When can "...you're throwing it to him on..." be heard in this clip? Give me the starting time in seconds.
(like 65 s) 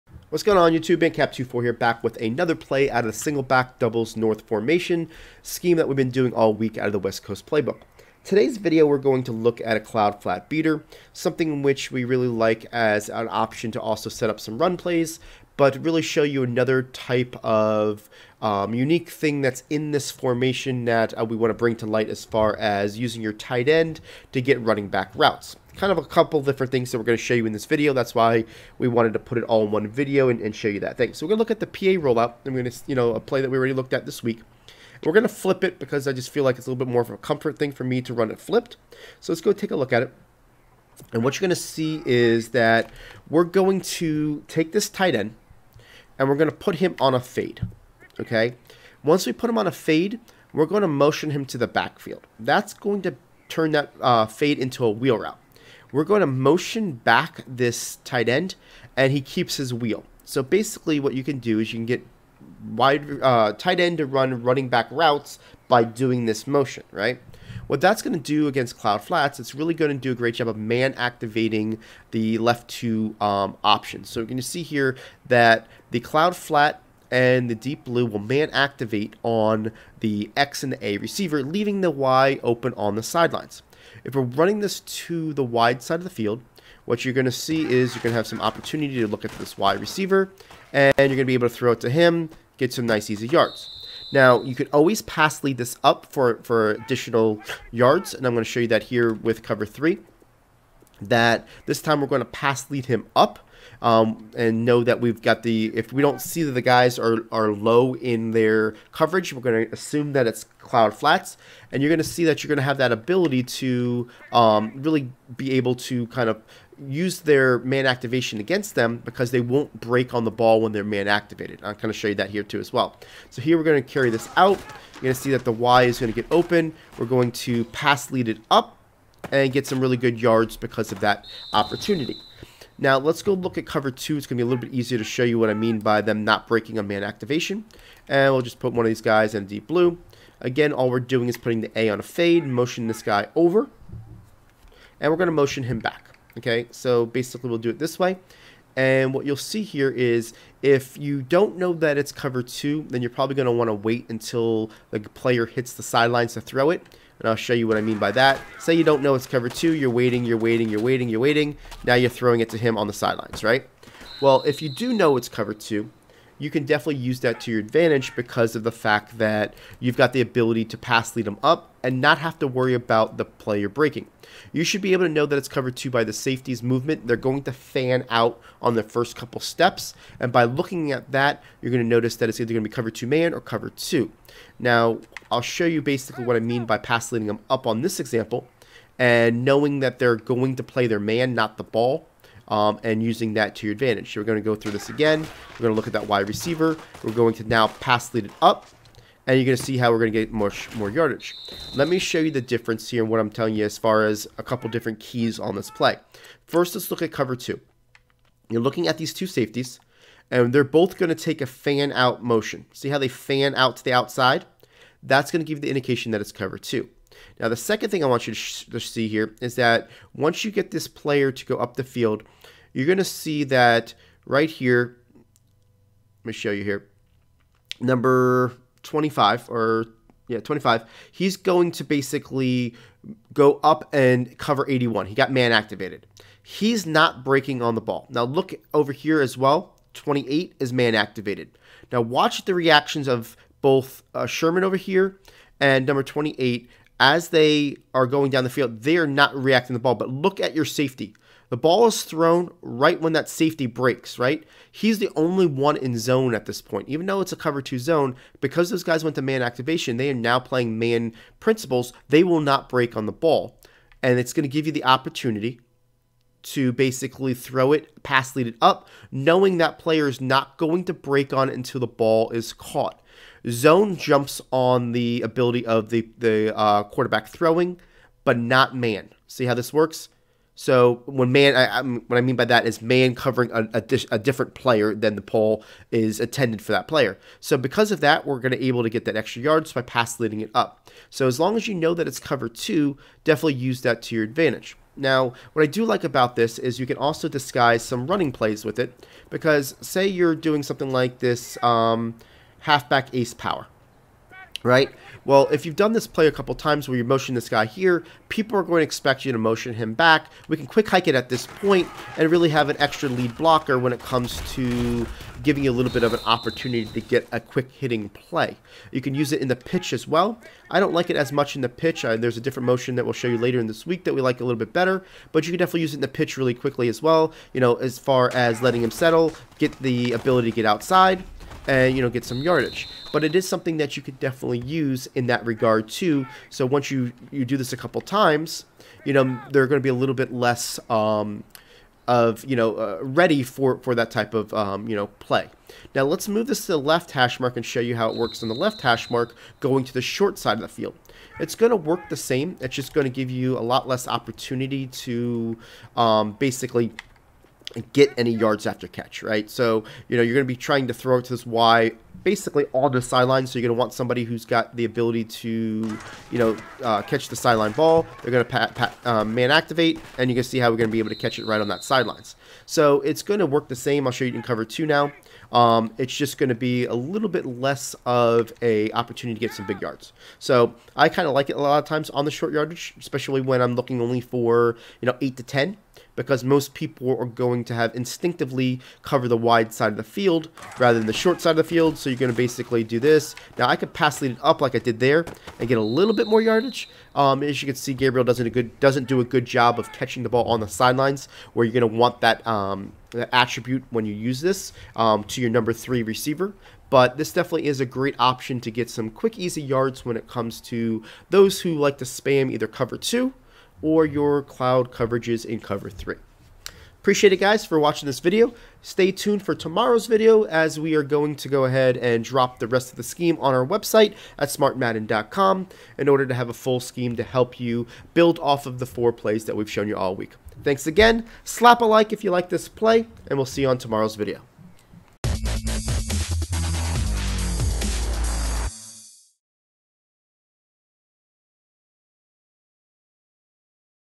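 161 s.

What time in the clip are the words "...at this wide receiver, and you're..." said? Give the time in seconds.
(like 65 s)
89 s.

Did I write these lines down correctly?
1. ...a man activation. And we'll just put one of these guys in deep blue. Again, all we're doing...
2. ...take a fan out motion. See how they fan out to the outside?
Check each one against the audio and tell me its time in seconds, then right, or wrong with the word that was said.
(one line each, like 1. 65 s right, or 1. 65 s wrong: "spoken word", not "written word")
1. 136 s right
2. 211 s right.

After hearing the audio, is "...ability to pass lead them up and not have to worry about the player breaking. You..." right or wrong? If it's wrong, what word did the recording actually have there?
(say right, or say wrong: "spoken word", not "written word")
right.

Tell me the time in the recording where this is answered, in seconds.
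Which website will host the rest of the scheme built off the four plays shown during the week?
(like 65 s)
424 s.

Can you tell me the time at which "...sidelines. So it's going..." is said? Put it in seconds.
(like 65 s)
371 s.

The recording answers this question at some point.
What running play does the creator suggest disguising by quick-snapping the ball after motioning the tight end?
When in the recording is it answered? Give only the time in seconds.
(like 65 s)
302 s.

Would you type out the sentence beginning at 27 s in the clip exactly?
That's why we wanted to put it all in one video and, and show you that thing.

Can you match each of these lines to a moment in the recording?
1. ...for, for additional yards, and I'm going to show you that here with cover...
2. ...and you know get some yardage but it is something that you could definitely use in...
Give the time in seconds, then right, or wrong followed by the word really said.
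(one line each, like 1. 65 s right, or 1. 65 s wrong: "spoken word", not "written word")
1. 96 s right
2. 331 s right.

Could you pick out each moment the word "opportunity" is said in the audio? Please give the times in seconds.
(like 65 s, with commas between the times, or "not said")
88 s, 131 s, 264 s, 316 s, 354 s, 378 s.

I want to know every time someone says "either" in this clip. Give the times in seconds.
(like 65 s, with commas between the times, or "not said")
182 s, 412 s.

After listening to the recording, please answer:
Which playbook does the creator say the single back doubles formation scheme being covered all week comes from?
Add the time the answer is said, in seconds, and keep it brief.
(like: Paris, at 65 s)
West Coast, at 6 s.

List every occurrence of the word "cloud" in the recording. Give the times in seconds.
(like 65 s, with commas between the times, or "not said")
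9 s, 68 s, 76 s, 110 s, 414 s.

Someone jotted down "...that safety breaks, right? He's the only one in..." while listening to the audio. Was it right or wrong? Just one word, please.
right.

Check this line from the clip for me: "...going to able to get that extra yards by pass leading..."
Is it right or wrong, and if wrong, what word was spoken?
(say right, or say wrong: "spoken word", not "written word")
right.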